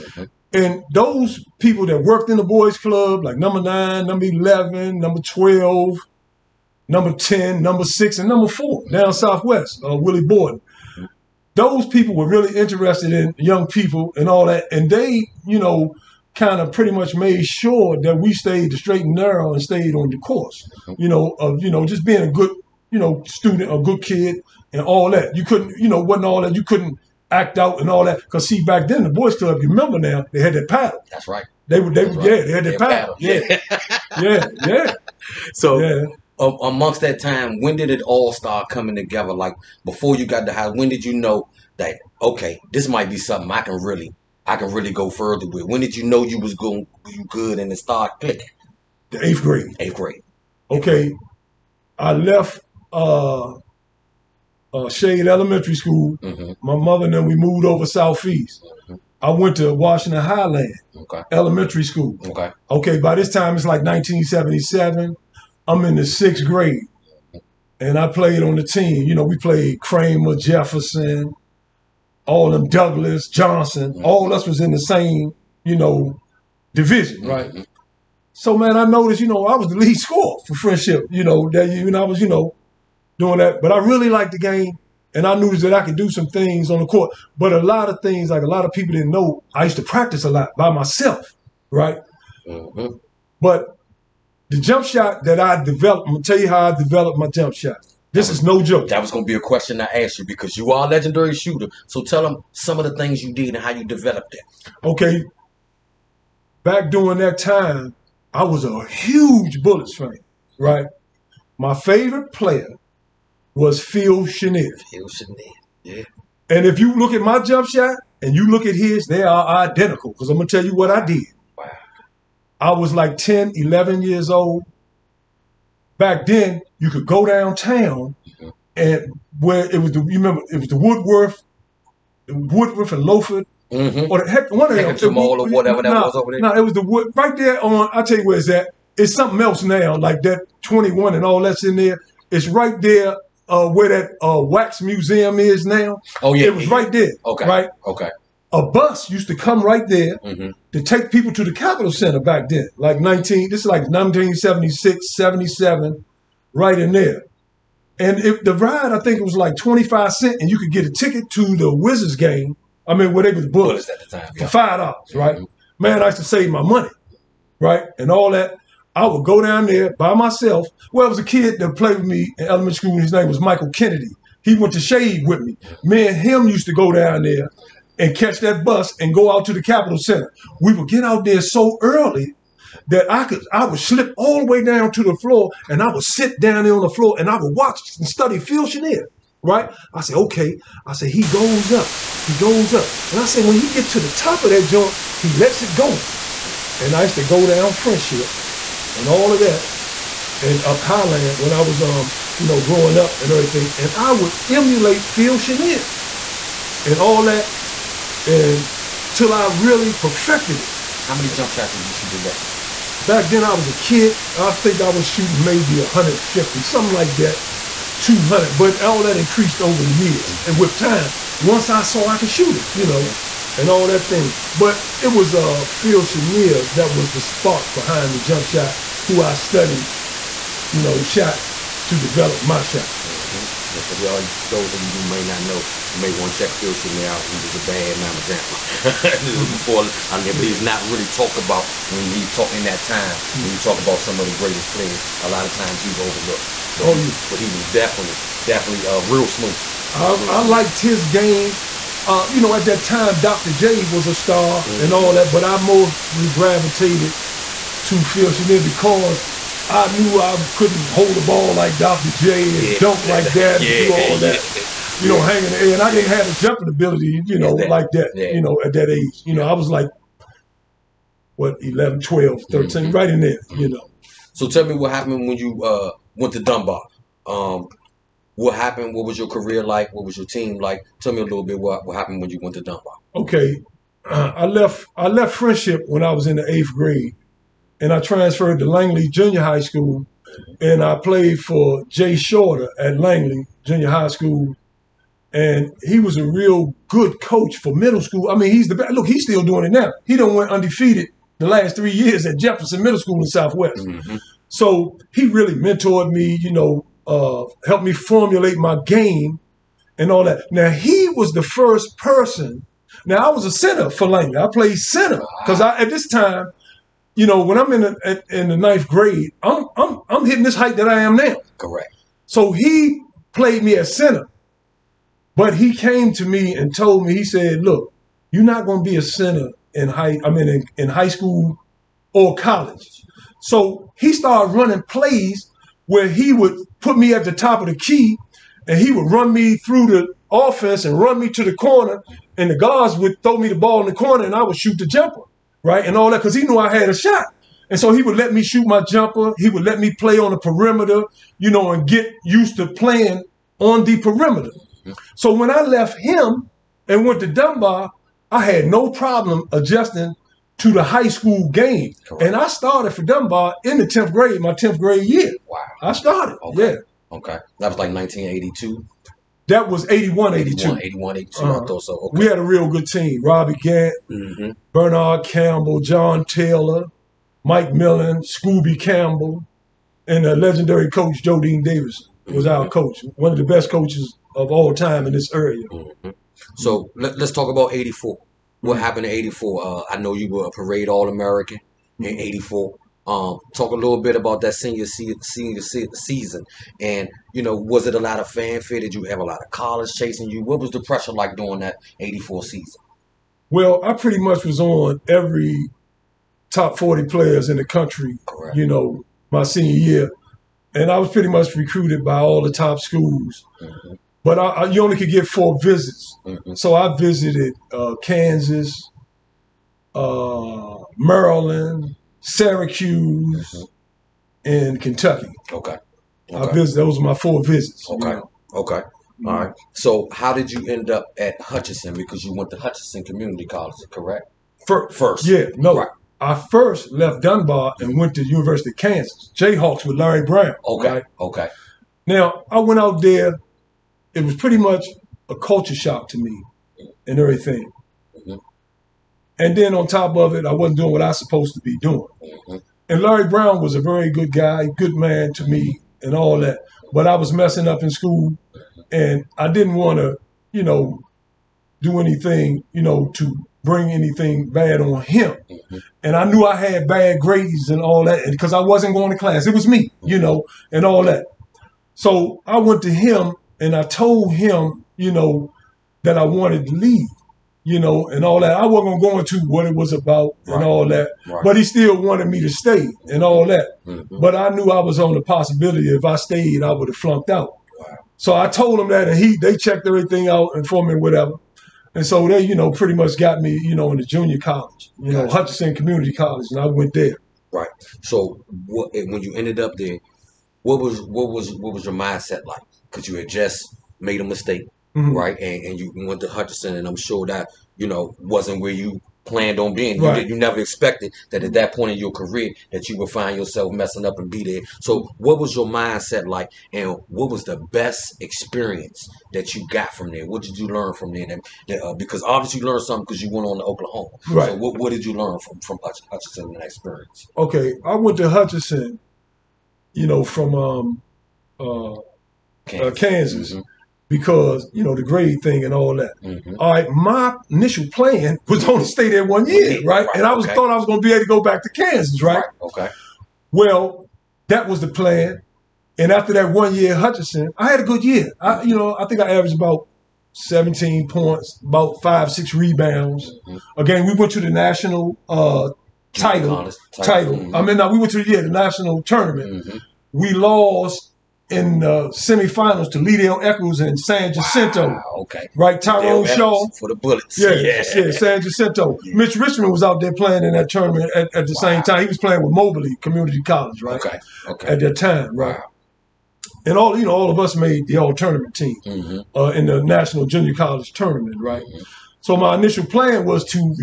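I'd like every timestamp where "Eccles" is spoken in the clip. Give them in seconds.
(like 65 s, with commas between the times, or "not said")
563 s.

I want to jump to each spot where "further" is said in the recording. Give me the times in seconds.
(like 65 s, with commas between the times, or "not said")
45 s.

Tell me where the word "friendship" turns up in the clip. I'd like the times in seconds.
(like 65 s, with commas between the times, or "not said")
80 s, 197 s, 285 s.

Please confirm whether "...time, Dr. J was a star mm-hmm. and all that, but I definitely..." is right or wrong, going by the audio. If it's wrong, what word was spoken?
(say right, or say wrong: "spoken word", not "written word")
wrong: "mostly", not "definitely".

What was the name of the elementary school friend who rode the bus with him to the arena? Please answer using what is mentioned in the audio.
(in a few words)
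Michael Kennedy.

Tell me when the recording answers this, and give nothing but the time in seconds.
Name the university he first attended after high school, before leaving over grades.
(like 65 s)
438 s.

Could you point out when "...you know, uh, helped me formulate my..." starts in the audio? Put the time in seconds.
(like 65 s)
306 s.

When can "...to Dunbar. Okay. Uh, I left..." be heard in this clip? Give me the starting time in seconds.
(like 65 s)
282 s.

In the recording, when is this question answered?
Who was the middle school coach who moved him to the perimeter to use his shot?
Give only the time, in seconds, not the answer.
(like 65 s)
291 s.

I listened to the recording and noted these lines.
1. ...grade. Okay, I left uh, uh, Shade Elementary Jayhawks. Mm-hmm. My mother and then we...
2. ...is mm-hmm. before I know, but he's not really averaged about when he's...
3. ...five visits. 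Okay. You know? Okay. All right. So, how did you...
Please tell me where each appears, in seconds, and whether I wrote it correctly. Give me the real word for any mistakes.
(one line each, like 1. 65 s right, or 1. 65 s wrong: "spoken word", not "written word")
1. 49 s wrong: "School", not "Jayhawks"
2. 239 s wrong: "talked", not "averaged"
3. 427 s wrong: "four", not "five".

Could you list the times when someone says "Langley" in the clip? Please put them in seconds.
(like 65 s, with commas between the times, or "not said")
288 s, 292 s, 314 s.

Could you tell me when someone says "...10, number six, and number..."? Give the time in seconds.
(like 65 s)
7 s.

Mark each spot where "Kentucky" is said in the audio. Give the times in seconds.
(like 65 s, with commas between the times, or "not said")
424 s.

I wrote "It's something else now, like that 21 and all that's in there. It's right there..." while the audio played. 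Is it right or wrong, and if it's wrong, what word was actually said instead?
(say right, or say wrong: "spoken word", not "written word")
right.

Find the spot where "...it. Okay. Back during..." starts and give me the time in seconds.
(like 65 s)
104 s.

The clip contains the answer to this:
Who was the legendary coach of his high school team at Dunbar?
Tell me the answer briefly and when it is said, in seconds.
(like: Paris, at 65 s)
Joe Dean Davis, at 381 s.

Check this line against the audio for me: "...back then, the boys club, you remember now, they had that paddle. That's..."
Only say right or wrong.
right.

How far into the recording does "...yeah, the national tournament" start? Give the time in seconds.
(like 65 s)
558 s.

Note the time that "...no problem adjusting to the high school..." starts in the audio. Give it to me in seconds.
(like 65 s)
358 s.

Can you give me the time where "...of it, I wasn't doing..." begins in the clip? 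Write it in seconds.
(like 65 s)
450 s.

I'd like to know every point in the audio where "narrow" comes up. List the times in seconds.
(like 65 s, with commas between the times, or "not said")
19 s.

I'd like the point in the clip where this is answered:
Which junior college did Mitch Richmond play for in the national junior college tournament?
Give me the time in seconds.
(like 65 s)
572 s.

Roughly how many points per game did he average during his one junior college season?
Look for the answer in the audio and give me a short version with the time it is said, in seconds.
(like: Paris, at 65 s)
17, at 550 s.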